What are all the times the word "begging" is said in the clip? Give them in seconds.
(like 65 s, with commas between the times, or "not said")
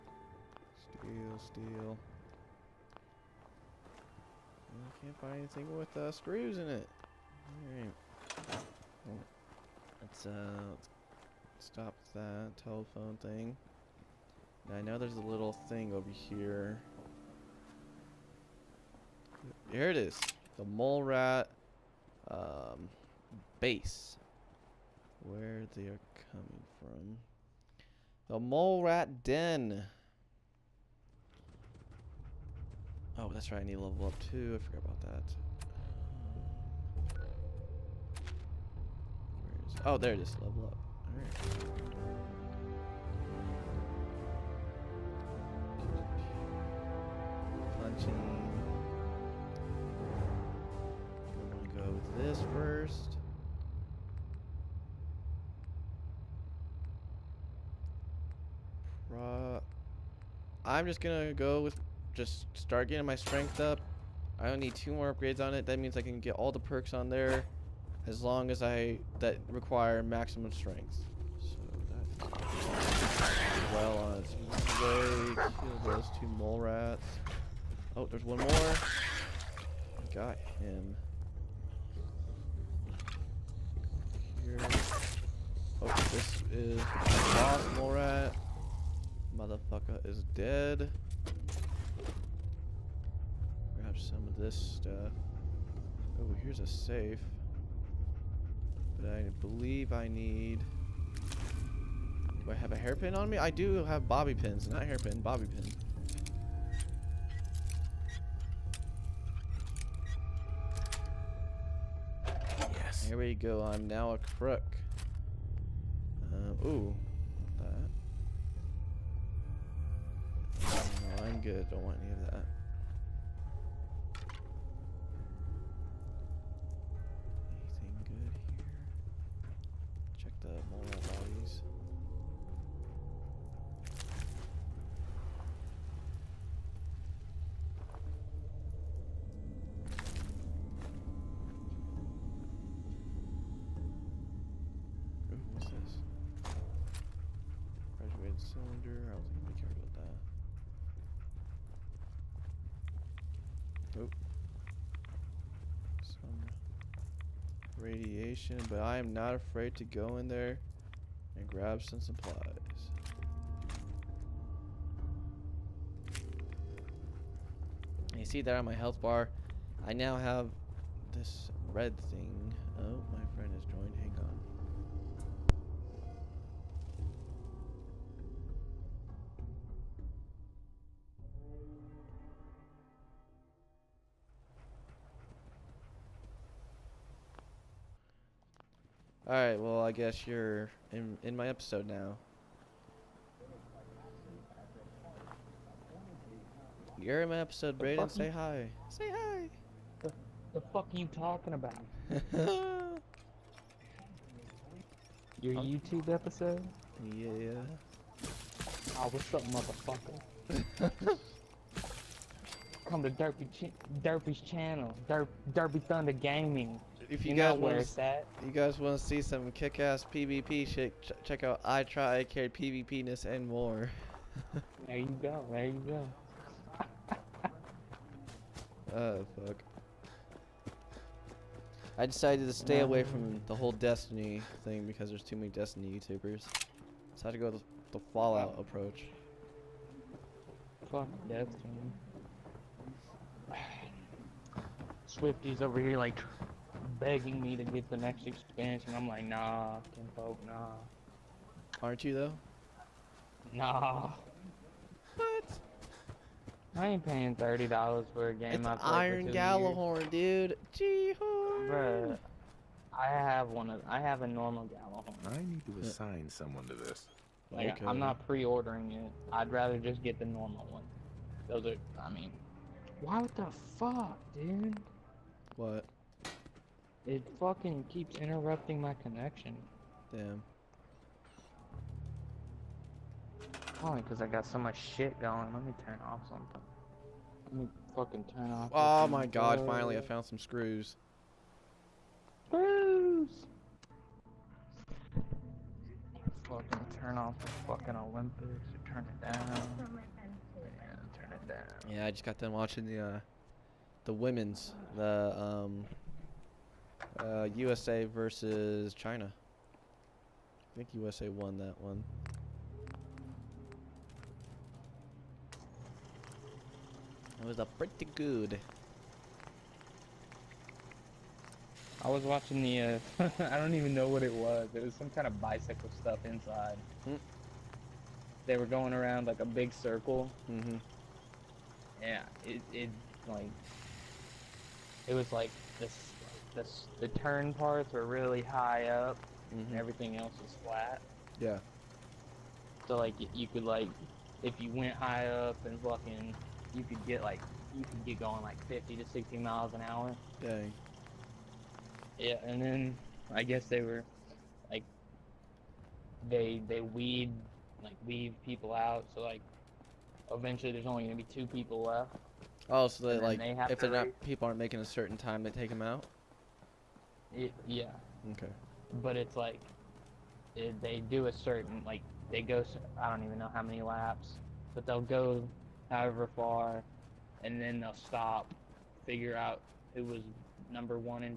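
246 s.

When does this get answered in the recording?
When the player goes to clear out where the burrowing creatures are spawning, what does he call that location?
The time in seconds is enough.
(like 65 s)
28 s.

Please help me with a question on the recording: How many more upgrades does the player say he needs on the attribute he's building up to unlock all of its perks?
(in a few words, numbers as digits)
2.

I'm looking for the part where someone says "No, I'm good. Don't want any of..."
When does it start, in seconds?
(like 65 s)
121 s.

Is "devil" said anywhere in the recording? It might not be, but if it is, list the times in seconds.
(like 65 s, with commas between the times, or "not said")
not said.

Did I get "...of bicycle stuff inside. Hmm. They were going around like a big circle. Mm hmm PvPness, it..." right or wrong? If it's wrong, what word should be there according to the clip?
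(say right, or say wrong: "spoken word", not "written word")
wrong: "Yeah", not "PvPness".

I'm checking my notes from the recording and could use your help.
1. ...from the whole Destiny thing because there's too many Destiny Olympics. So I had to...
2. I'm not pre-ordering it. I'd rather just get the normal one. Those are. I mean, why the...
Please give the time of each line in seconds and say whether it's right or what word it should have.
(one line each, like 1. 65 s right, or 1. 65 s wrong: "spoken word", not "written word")
1. 233 s wrong: "YouTubers", not "Olympics"
2. 267 s right.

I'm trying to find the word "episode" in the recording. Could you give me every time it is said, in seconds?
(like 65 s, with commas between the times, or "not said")
191 s, 197 s, 206 s.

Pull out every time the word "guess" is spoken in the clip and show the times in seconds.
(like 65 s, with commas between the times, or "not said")
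189 s, 353 s.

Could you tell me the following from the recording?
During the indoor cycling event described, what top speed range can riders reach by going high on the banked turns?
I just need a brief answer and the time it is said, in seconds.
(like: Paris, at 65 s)
50 to 60 mph, at 348 s.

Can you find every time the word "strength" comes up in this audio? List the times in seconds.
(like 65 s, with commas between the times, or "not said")
63 s, 70 s.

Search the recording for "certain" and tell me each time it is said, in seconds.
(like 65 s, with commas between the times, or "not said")
364 s, 371 s.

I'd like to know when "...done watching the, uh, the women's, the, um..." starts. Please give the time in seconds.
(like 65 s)
302 s.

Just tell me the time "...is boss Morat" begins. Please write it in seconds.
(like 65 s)
86 s.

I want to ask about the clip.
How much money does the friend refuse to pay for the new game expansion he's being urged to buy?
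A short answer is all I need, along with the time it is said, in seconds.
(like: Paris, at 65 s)
30 dollars, at 257 s.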